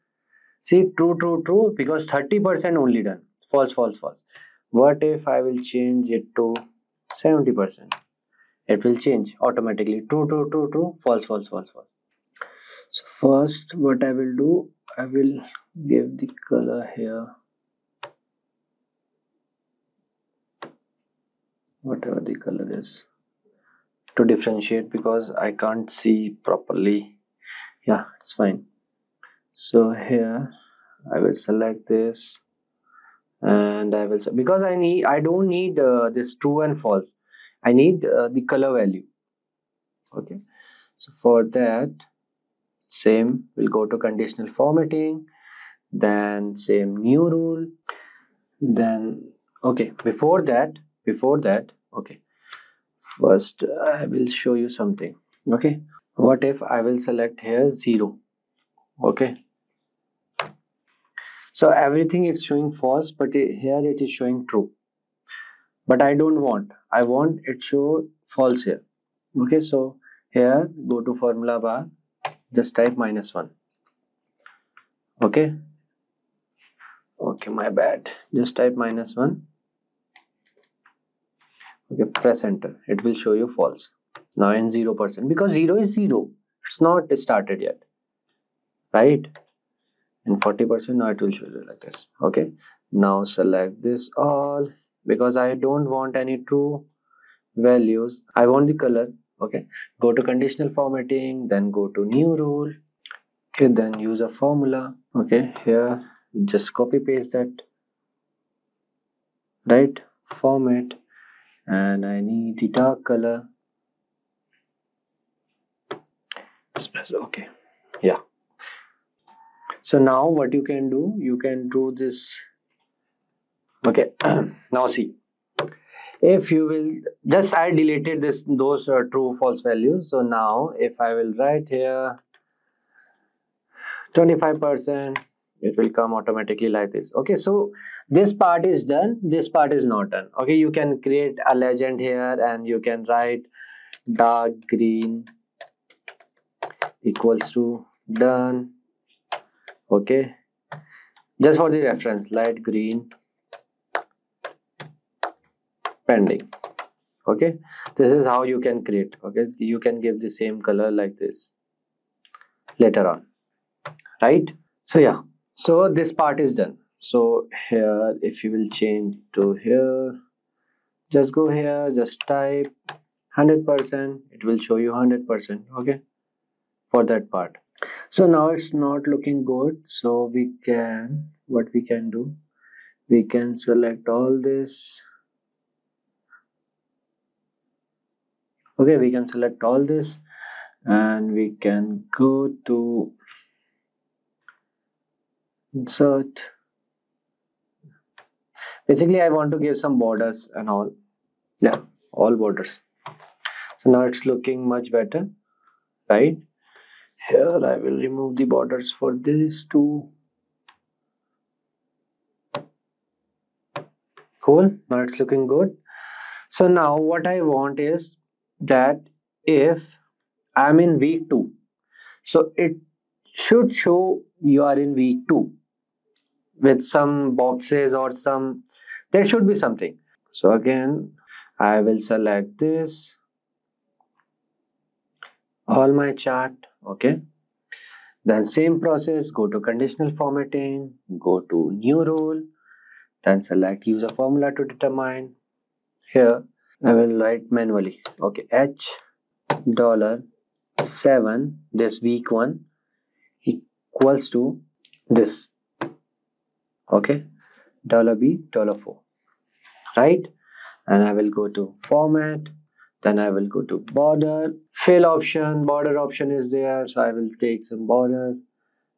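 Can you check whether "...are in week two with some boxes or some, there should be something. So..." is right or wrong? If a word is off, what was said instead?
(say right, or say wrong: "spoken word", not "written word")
right.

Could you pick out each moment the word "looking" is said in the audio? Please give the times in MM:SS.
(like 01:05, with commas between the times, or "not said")
02:59, 03:24, 03:35.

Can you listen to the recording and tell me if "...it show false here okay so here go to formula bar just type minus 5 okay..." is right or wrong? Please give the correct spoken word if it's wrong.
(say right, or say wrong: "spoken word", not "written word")
wrong: "1", not "5".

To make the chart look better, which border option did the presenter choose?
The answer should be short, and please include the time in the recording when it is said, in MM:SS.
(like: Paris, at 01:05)
All borders, at 03:22.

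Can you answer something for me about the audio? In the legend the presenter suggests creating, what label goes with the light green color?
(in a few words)
pending.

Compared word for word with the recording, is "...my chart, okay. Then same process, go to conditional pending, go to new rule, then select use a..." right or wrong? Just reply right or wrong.
wrong.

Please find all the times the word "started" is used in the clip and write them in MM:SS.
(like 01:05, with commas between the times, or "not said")
01:27.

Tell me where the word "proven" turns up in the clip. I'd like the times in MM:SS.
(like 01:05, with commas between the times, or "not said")
not said.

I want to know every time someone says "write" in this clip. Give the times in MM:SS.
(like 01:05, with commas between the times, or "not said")
02:11, 02:23, 04:07.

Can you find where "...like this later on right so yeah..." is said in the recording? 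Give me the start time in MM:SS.
02:40.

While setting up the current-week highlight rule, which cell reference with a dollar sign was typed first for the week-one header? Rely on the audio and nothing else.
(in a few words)
H$7.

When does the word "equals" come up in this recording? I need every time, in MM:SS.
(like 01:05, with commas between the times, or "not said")
02:27, 04:13.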